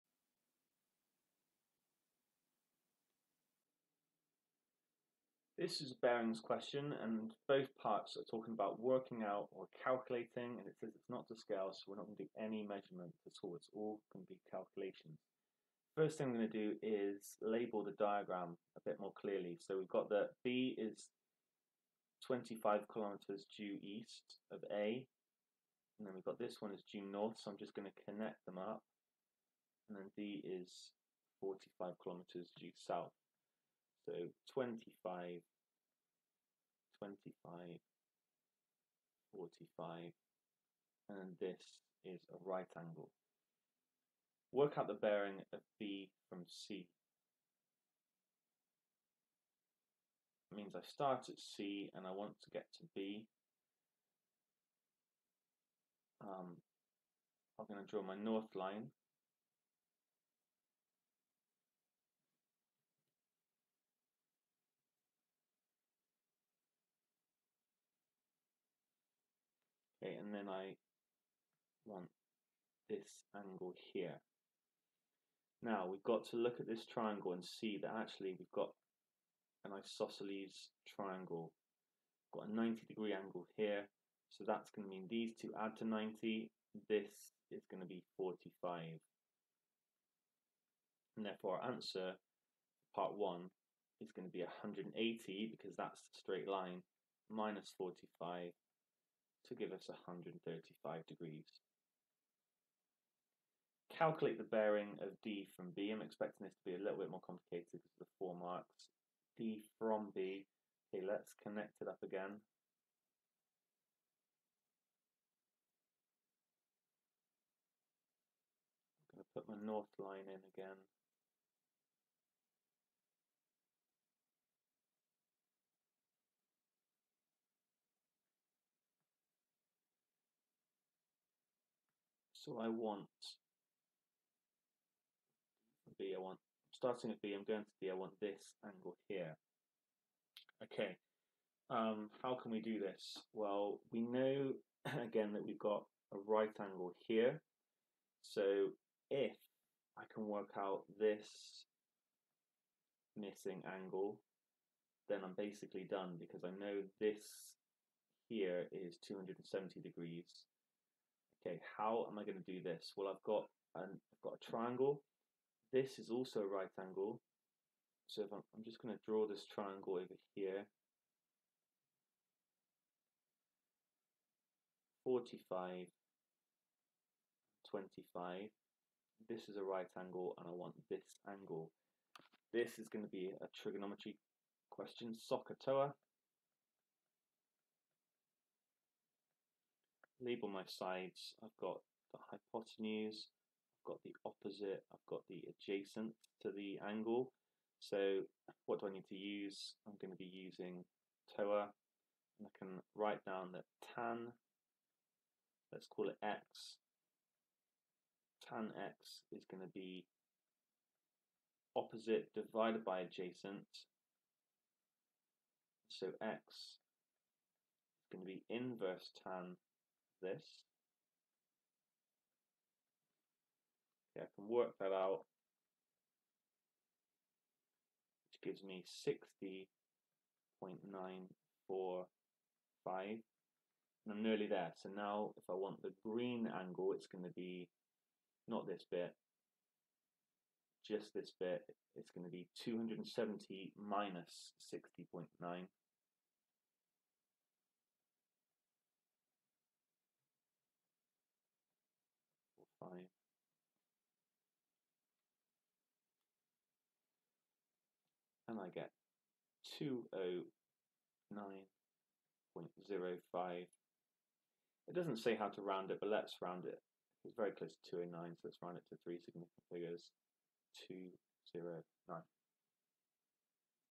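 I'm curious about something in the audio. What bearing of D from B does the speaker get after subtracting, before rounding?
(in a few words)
209.05.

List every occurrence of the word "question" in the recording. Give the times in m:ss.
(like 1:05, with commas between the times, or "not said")
0:06, 3:04.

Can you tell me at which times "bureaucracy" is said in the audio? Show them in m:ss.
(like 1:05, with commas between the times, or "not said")
not said.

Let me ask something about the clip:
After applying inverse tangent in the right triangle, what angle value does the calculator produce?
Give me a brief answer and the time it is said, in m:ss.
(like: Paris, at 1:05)
60.945, at 3:50.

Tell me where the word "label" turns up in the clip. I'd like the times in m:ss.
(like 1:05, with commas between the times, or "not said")
0:17, 3:10.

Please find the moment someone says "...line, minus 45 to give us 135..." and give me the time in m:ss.
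1:36.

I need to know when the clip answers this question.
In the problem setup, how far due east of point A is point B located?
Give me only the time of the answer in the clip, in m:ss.
0:22.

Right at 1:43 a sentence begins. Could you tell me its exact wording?
Calculate the bearing of D from B.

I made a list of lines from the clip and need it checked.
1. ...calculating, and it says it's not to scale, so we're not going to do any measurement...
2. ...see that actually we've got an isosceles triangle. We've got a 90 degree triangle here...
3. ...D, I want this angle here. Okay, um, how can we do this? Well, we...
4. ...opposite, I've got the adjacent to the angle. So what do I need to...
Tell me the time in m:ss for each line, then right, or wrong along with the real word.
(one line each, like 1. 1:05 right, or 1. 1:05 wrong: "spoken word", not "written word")
1. 0:09 right
2. 1:17 wrong: "angle", not "triangle"
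3. 2:17 right
4. 3:14 right.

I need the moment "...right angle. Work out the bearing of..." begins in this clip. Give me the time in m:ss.
0:42.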